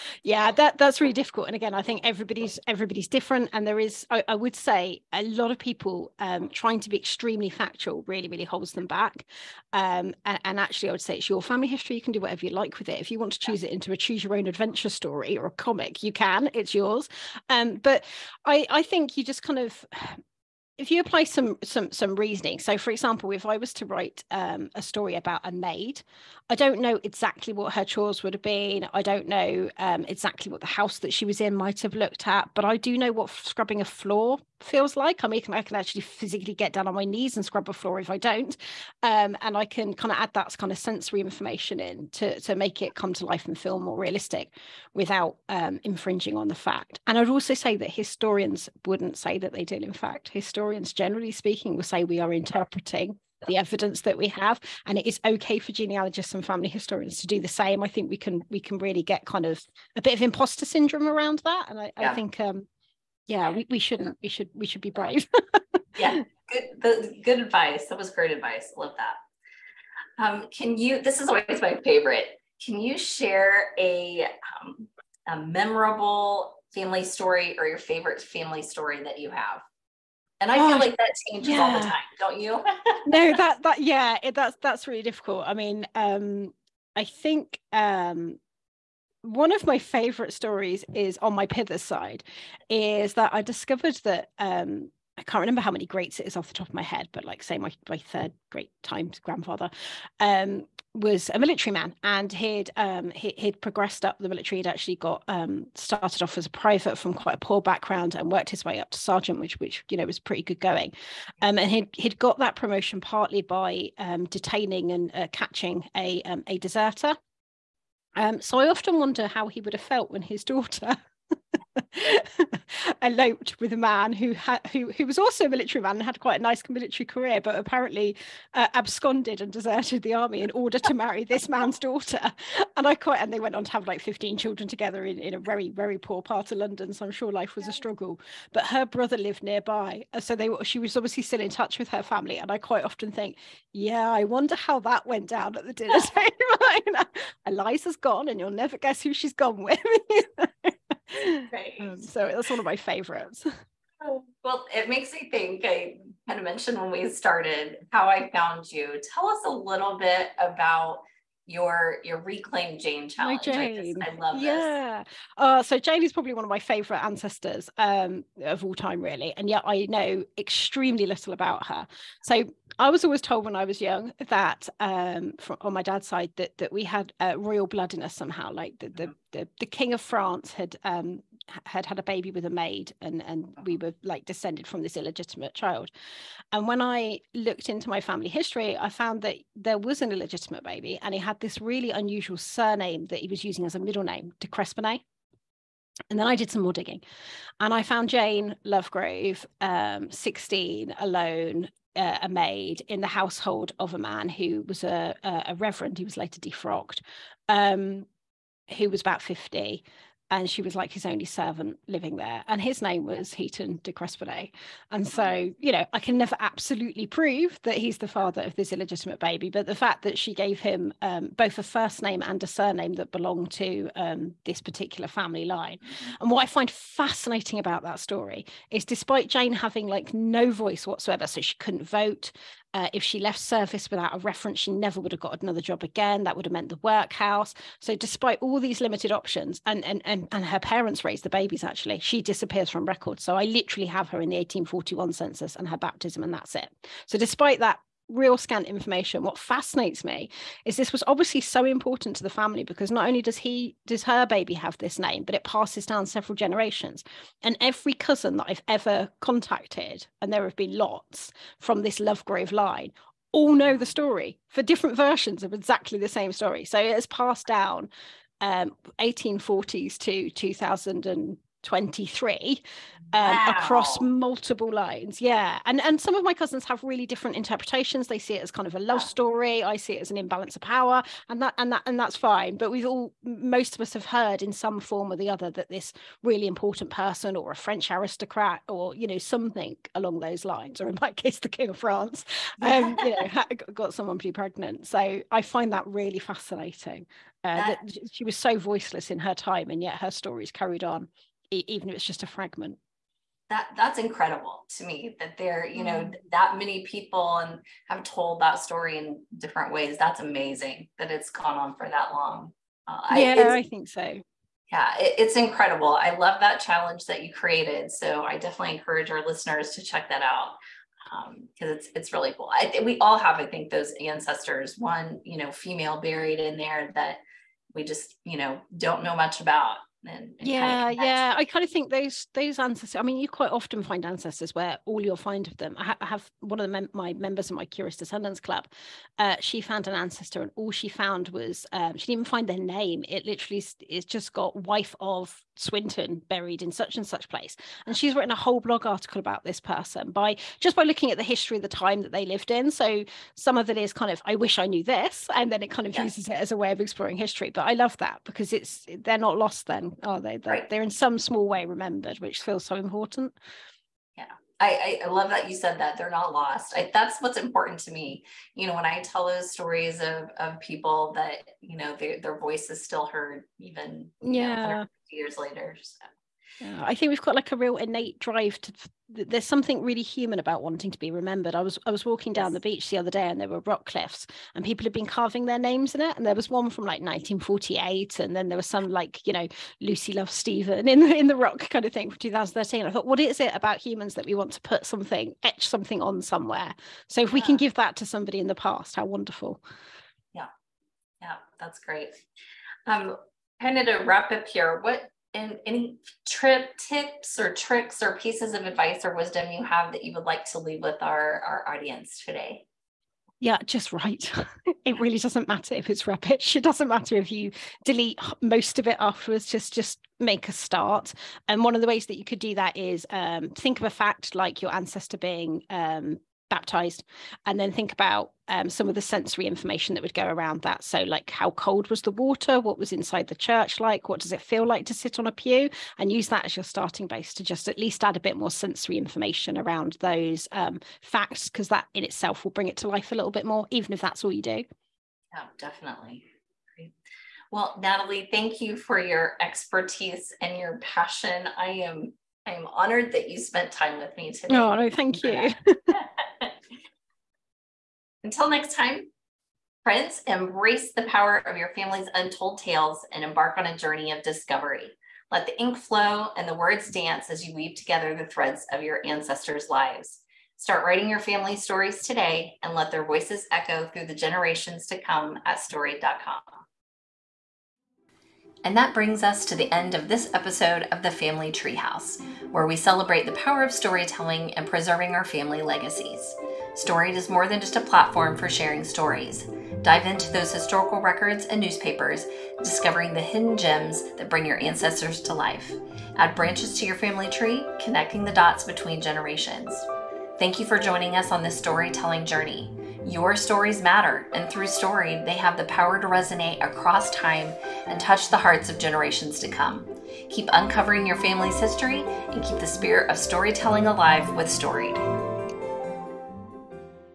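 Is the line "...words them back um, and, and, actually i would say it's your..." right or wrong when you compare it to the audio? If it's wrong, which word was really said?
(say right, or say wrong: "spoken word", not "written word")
wrong: "holds", not "words".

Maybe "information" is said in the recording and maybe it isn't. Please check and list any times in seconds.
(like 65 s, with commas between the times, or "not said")
41 s, 248 s, 429 s, 438 s.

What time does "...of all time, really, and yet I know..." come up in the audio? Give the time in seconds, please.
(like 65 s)
168 s.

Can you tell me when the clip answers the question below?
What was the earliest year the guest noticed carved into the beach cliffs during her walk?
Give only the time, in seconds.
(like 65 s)
387 s.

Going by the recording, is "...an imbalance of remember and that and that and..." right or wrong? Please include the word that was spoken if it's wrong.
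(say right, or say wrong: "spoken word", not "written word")
wrong: "power", not "remember".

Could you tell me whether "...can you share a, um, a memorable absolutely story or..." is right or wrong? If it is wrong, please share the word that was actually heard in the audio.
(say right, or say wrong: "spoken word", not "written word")
wrong: "family", not "absolutely".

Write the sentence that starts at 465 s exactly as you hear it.
Let the ink flow and the words dance as you weave together the threads of your ancestors' lives.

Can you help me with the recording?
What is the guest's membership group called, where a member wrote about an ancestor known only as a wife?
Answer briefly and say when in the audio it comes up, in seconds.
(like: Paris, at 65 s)
Curious Descendants Club, at 337 s.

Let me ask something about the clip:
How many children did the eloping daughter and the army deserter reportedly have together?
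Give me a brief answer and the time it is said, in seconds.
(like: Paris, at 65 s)
15, at 134 s.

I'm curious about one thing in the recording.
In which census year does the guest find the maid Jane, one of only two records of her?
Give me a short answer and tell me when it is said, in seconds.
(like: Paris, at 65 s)
1841, at 244 s.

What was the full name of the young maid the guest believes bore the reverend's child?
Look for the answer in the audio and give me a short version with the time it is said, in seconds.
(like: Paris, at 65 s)
Jane Lovegrove, at 198 s.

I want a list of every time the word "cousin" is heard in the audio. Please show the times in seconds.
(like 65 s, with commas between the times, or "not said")
257 s, 276 s.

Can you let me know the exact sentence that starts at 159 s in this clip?
Tell us a little bit about your your reclaim Jane challenge.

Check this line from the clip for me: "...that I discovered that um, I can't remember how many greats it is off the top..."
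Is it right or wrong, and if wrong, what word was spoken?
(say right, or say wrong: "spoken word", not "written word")
right.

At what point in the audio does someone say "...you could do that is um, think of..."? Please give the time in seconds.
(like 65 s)
422 s.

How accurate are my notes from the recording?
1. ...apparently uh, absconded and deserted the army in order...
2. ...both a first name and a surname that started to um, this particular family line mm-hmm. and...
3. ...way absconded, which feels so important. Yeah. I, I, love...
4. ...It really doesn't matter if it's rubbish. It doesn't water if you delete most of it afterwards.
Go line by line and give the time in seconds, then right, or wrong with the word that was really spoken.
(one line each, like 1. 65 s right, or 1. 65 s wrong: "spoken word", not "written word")
1. 127 s right
2. 221 s wrong: "belonged", not "started"
3. 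361 s wrong: "remembered", not "absconded"
4. 414 s wrong: "matter", not "water".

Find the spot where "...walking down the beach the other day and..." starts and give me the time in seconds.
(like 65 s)
382 s.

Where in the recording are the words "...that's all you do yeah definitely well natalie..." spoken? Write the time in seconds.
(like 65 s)
444 s.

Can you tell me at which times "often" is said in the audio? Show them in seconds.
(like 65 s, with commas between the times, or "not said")
118 s, 142 s, 333 s.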